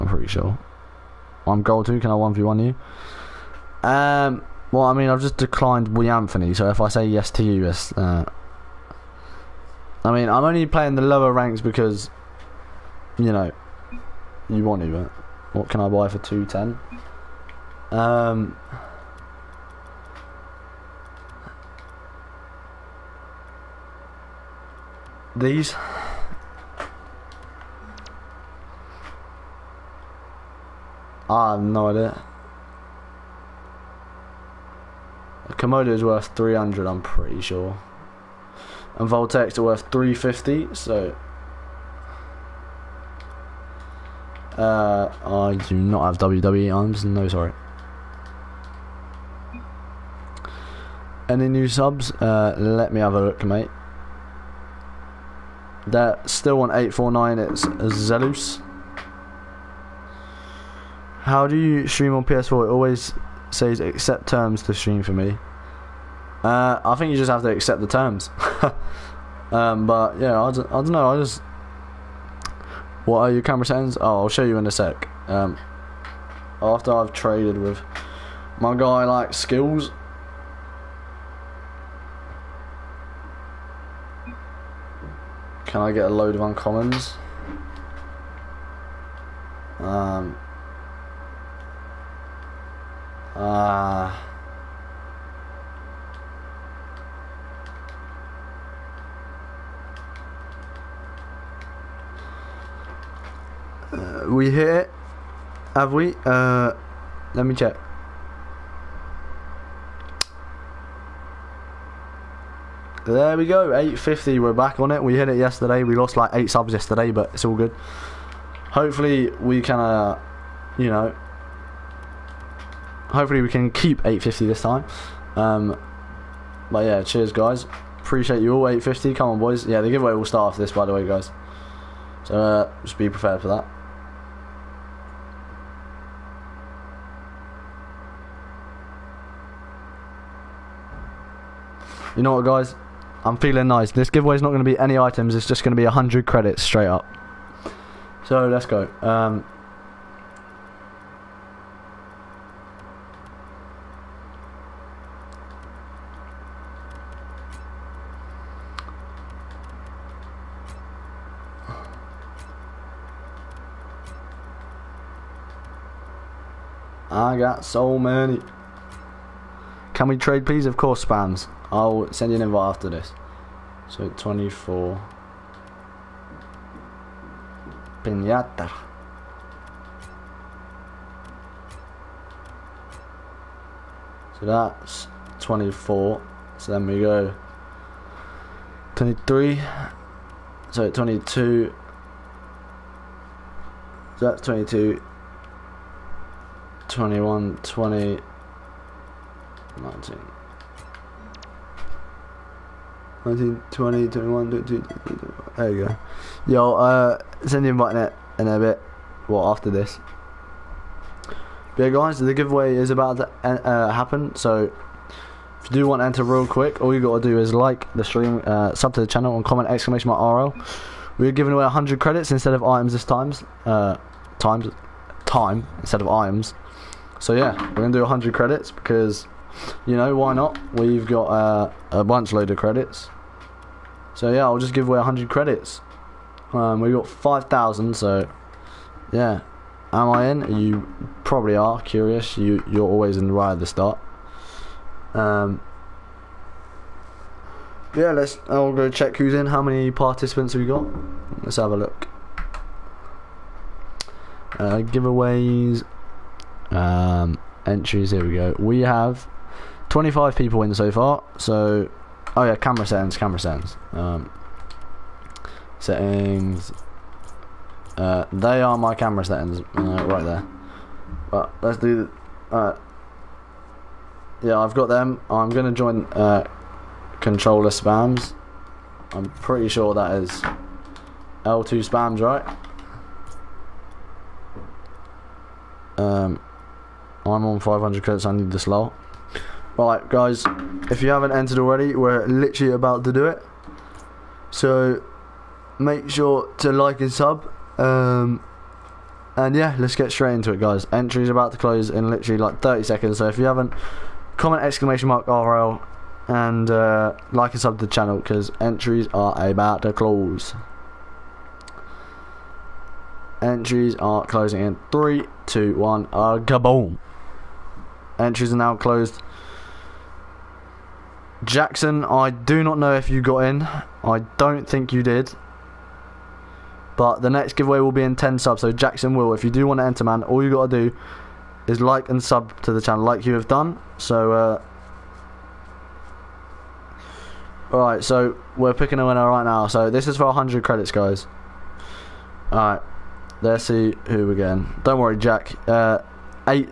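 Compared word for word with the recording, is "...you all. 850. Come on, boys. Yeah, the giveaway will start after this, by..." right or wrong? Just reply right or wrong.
right.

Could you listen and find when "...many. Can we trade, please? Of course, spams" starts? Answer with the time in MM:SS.
02:47.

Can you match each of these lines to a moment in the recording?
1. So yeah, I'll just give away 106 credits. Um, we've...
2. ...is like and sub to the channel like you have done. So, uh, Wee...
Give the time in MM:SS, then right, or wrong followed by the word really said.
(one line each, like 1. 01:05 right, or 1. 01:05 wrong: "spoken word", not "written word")
1. 03:54 wrong: "100", not "106"
2. 05:31 wrong: "Alright", not "Wee".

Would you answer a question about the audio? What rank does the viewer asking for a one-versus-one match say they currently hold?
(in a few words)
Gold 2.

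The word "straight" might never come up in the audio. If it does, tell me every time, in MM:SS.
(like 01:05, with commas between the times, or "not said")
02:26, 05:00.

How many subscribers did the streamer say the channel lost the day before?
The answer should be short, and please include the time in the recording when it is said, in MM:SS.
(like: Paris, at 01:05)
8, at 01:56.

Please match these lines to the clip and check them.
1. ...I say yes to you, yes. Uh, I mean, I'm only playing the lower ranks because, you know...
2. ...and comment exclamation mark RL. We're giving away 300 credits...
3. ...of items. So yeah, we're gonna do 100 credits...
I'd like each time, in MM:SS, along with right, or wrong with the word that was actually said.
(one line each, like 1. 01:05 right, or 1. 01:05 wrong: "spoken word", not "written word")
1. 00:06 right
2. 03:39 wrong: "100", not "300"
3. 03:46 right.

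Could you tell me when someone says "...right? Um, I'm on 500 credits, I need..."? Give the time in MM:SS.
04:42.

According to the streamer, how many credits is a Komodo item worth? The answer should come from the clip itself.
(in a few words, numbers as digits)
300.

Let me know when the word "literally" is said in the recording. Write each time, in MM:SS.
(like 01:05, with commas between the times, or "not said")
04:52, 05:02.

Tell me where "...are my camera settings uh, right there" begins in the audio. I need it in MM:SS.
04:28.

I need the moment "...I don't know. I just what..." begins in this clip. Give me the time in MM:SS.
01:10.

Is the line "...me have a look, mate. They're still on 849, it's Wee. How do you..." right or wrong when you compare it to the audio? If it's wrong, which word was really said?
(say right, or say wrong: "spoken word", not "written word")
wrong: "Zelus", not "Wee".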